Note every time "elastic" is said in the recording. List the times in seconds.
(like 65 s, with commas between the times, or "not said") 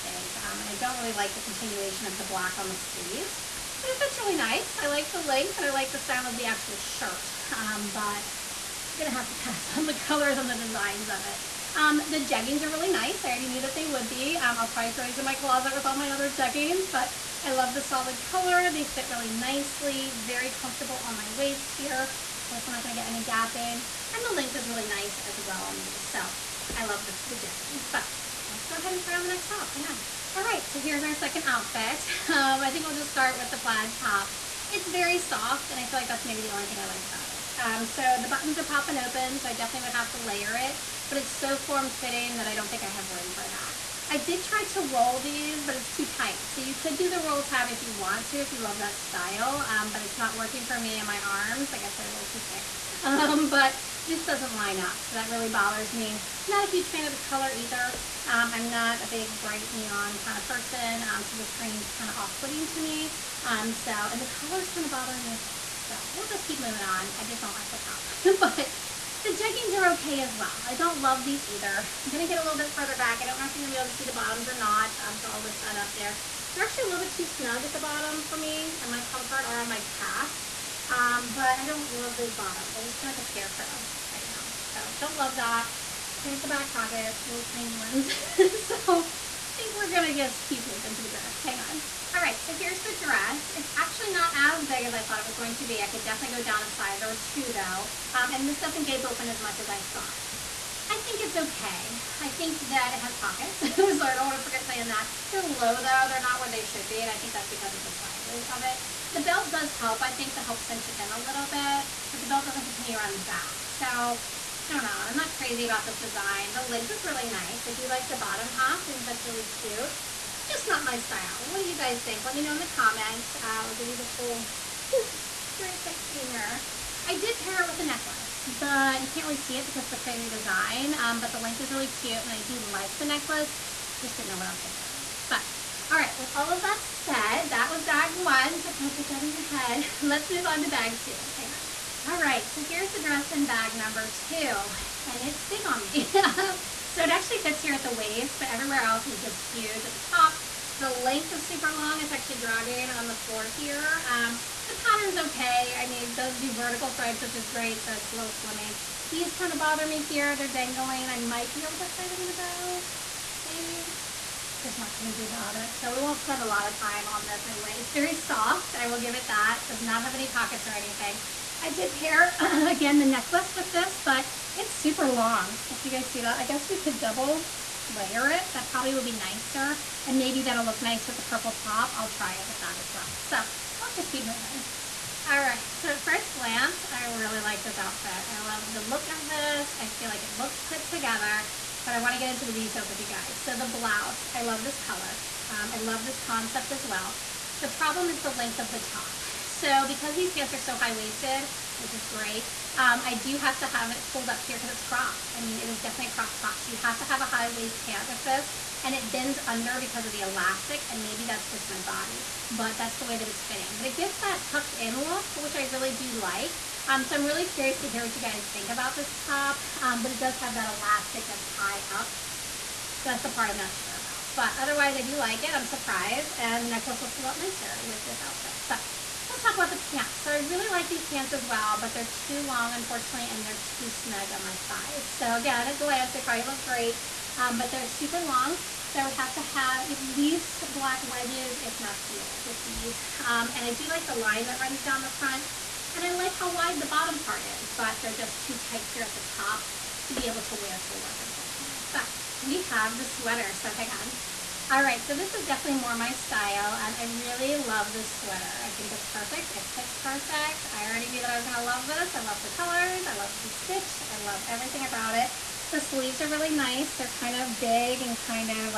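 210 s, 220 s.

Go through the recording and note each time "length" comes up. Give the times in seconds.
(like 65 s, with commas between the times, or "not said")
5 s, 24 s, 116 s, 131 s, 150 s, 198 s.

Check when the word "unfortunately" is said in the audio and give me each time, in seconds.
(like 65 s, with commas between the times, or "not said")
232 s, 251 s.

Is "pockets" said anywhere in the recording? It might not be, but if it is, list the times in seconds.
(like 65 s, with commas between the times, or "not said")
86 s, 103 s, 170 s.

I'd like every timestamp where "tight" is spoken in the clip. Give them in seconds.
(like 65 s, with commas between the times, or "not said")
46 s, 248 s.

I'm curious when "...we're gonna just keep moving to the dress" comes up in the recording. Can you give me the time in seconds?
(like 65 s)
89 s.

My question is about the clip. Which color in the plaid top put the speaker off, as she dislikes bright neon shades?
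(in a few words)
green.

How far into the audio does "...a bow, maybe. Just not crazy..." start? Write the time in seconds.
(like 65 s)
162 s.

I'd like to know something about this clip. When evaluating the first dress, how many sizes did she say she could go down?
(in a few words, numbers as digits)
a size or two.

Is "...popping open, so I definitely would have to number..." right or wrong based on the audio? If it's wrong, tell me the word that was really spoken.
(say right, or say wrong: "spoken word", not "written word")
wrong: "layer", not "number".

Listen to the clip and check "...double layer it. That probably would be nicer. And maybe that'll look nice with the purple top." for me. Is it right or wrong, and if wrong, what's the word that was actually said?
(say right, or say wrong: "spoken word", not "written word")
right.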